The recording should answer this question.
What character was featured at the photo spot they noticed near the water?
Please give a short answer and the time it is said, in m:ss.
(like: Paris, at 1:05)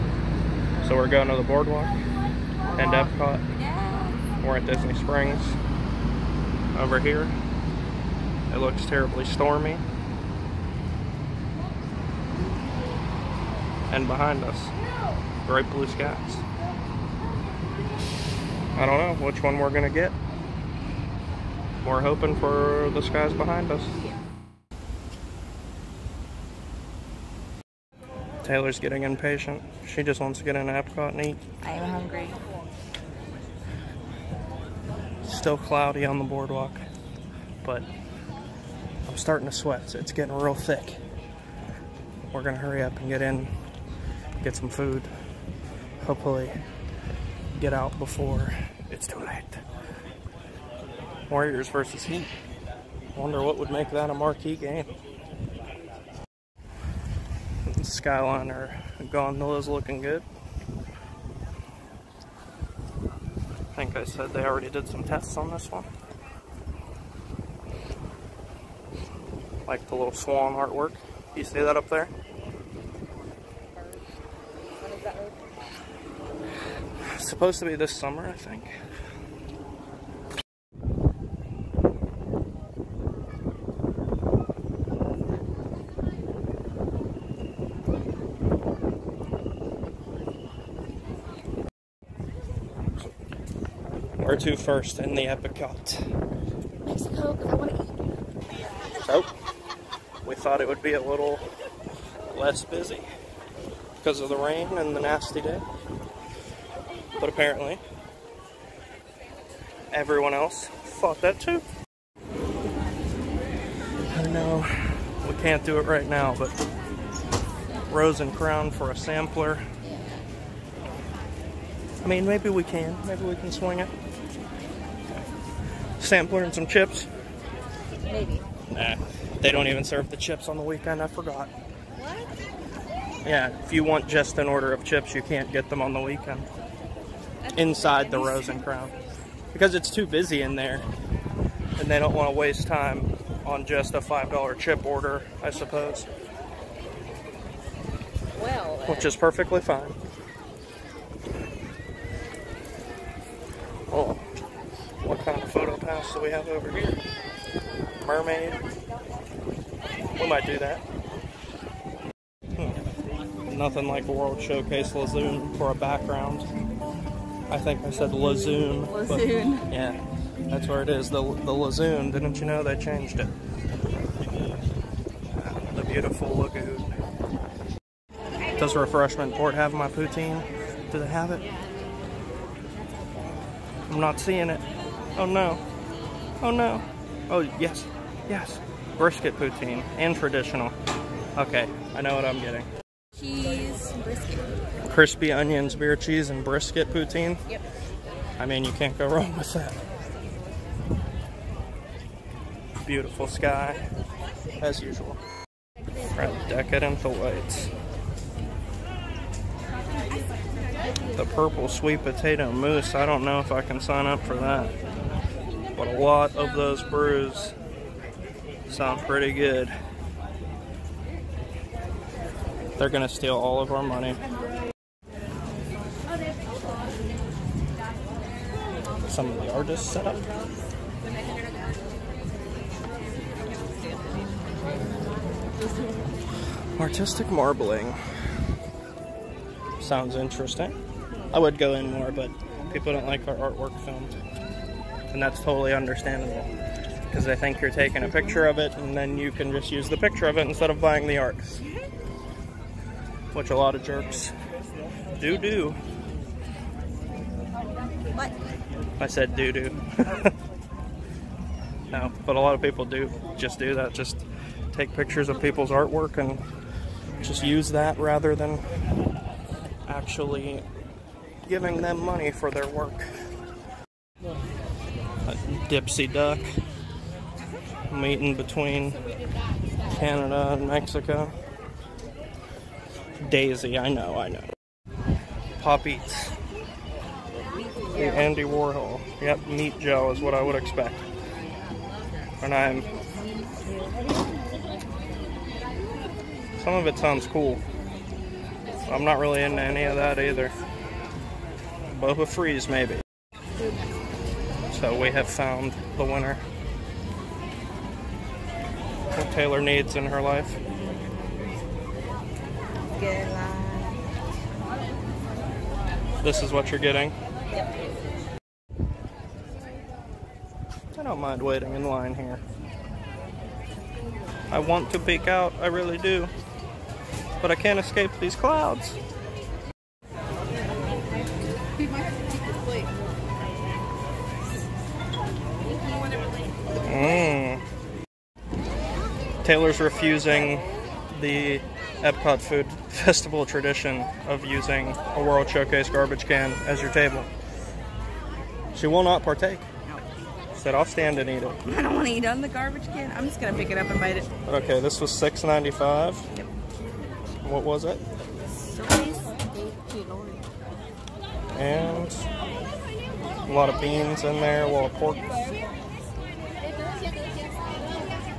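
Mermaid, at 2:38.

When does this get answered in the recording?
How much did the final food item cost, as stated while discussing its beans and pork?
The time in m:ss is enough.
5:55.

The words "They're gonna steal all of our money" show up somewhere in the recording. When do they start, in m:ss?
3:42.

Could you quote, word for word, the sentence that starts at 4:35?
Dipsy Duck meeting between Canada and Mexico.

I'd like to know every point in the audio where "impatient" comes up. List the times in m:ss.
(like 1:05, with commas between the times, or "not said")
0:29.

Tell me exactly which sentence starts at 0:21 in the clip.
We're hoping for the skies behind us.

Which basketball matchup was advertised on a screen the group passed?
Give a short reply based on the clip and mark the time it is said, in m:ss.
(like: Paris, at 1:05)
Warriors versus Heat, at 0:51.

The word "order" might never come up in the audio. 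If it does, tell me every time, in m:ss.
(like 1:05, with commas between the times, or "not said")
2:14, 2:24.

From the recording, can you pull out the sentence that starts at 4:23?
Just take pictures of people's artwork and just use that rather than actually giving them money for their work.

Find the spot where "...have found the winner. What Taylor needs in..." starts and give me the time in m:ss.
5:05.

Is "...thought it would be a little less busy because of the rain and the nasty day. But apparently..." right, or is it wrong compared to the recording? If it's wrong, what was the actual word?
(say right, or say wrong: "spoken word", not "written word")
right.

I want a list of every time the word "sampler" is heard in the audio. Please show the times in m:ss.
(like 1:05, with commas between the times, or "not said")
1:58, 2:06.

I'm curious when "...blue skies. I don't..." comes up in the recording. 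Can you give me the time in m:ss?
0:15.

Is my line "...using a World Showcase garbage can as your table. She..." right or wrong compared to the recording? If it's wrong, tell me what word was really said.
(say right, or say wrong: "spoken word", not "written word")
right.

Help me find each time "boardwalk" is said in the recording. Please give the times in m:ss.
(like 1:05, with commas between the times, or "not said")
0:01, 0:36.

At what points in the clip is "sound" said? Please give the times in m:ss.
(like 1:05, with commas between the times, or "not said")
3:38, 3:59, 4:56.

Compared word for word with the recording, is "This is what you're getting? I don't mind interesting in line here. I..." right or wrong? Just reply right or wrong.
wrong.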